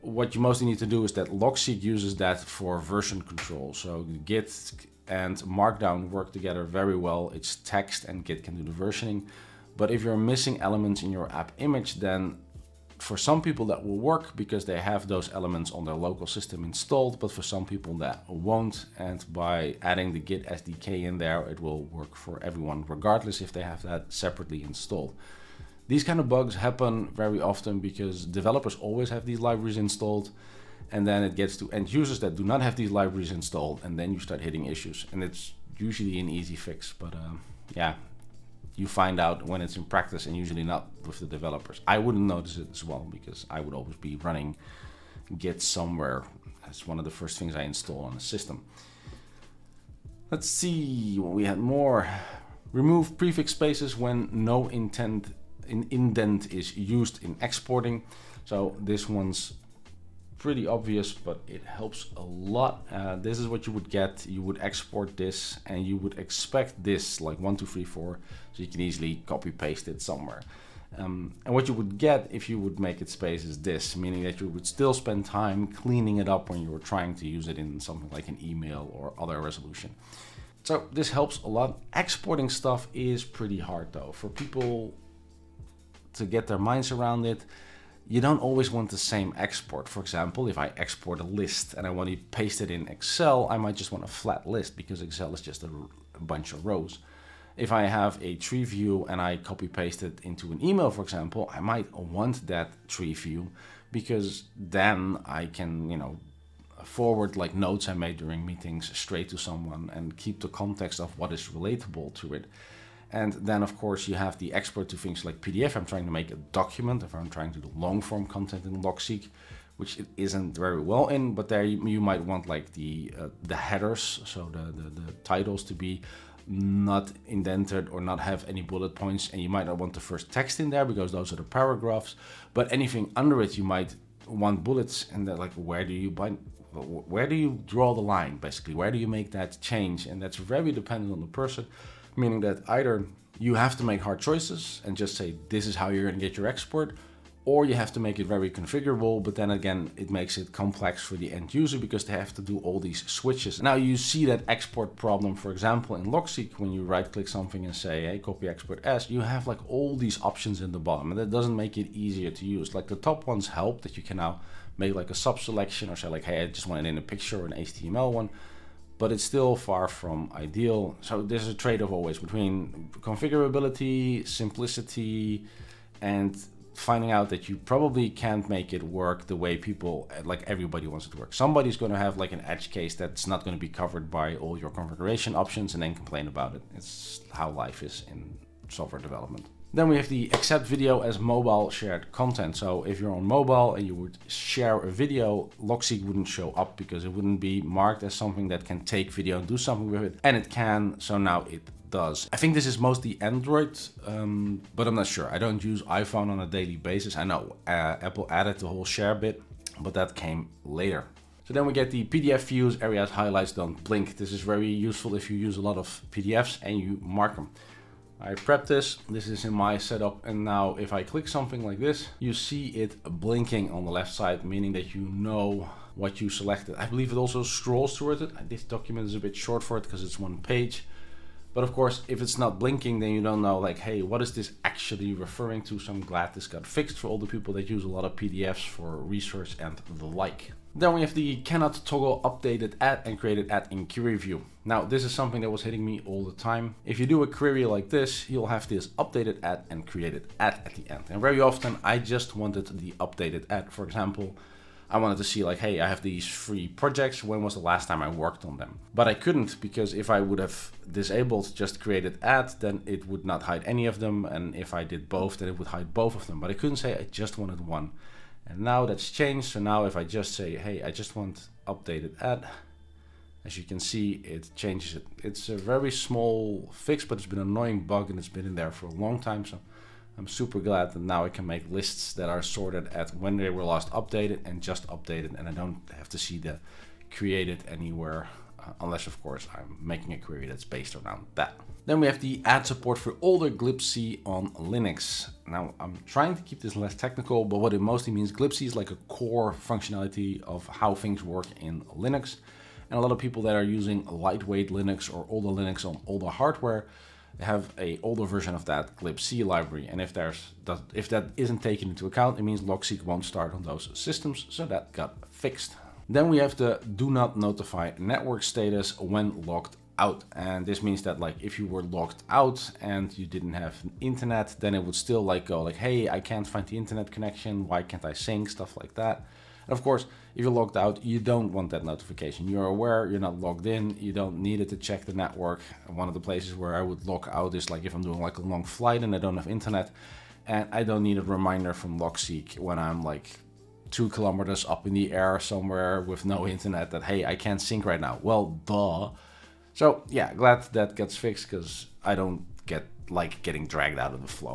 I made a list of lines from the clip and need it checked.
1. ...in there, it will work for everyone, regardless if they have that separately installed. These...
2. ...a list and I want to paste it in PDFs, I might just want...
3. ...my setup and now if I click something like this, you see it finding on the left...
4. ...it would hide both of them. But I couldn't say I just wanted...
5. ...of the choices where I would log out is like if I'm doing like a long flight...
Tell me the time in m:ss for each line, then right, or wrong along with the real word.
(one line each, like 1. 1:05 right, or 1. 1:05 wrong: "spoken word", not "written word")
1. 0:21 right
2. 1:31 wrong: "Excel", not "PDFs"
3. 3:39 wrong: "blinking", not "finding"
4. 4:25 right
5. 5:36 wrong: "places", not "choices".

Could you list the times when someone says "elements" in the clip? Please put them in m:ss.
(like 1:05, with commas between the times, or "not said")
0:10, 0:15.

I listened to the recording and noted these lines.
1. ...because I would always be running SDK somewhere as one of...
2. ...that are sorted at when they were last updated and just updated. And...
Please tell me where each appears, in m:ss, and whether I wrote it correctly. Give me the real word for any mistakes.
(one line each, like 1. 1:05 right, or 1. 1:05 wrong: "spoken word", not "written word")
1. 0:43 wrong: "Git", not "SDK"
2. 4:42 right.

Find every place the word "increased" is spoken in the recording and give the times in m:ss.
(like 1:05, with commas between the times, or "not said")
not said.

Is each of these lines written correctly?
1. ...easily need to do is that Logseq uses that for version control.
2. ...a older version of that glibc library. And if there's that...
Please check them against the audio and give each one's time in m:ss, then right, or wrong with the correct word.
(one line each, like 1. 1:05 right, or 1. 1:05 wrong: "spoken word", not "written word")
1. 0:00 wrong: "mostly", not "easily"
2. 5:07 right.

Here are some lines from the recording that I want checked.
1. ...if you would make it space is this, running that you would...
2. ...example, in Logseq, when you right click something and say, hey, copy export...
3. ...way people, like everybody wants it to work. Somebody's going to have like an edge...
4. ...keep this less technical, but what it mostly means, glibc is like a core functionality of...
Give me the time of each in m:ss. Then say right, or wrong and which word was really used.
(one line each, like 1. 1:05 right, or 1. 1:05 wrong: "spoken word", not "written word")
1. 1:12 wrong: "meaning", not "running"
2. 2:35 right
3. 2:59 right
4. 4:56 right.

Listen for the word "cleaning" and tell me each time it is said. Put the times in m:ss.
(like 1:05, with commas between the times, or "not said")
1:15.